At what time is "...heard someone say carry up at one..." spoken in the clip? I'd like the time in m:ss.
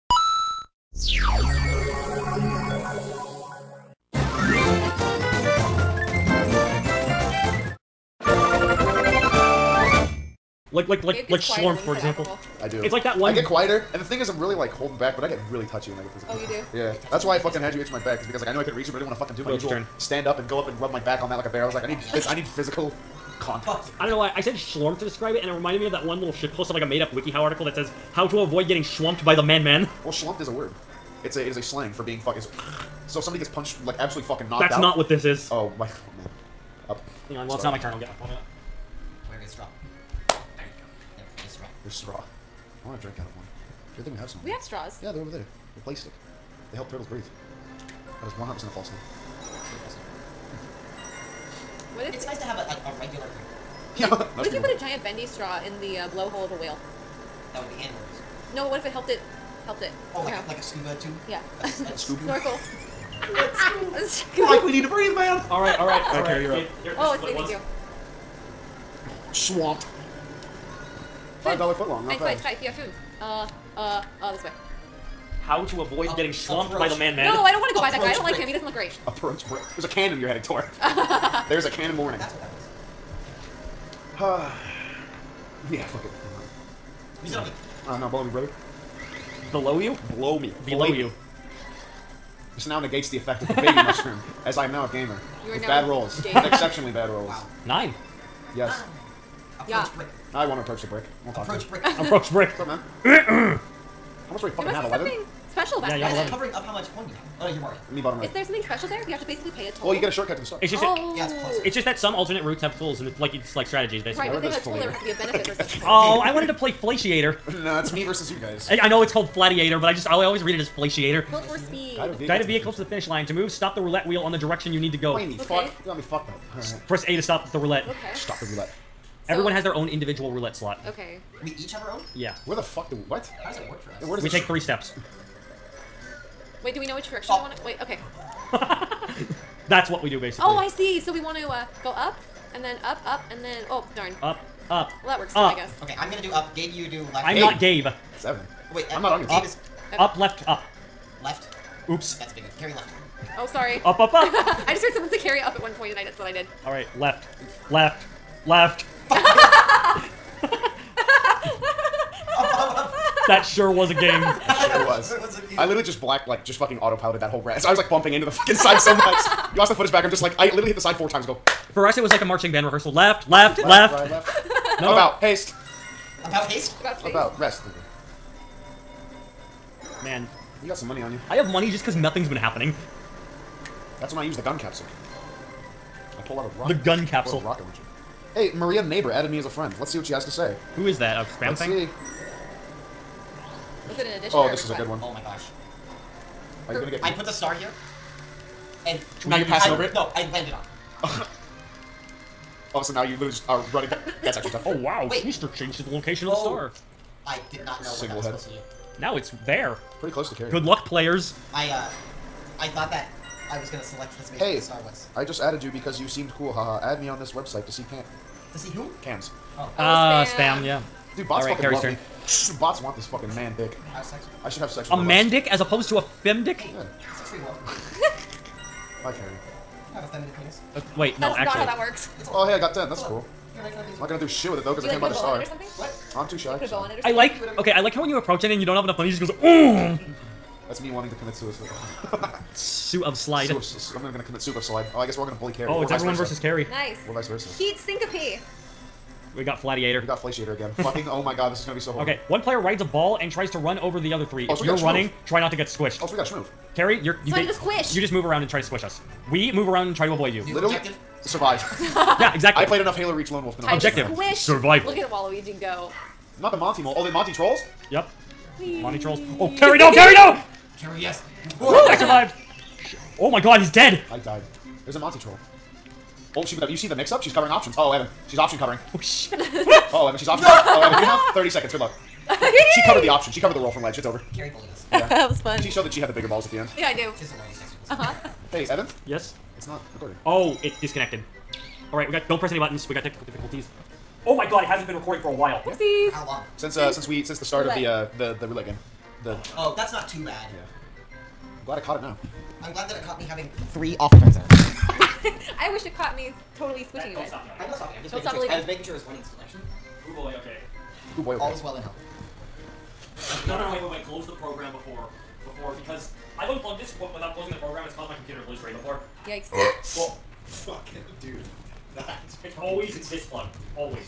2:34.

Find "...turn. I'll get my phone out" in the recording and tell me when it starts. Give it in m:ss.
0:37.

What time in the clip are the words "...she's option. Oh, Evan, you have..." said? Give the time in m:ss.
4:40.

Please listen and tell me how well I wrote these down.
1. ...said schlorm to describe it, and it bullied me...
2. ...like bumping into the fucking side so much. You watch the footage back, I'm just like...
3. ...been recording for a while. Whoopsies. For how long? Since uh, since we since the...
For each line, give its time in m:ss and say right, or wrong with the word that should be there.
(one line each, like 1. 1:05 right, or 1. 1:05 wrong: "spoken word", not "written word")
1. 0:24 wrong: "reminded", not "bullied"
2. 2:47 right
3. 4:54 right.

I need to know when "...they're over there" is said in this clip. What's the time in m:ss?
0:45.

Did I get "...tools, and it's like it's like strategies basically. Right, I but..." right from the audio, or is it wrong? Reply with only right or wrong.
right.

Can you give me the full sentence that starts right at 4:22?
I played enough Halo Reach Lone Wolf to know.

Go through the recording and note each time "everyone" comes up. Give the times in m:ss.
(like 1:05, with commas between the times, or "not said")
2:09, 4:05.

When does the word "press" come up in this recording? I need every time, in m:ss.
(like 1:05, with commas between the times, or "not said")
2:06, 4:52.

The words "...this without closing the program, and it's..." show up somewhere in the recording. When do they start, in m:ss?
5:16.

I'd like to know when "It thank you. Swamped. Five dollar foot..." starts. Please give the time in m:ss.
1:07.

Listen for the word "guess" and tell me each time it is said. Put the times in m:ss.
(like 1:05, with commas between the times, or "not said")
2:25, 4:05.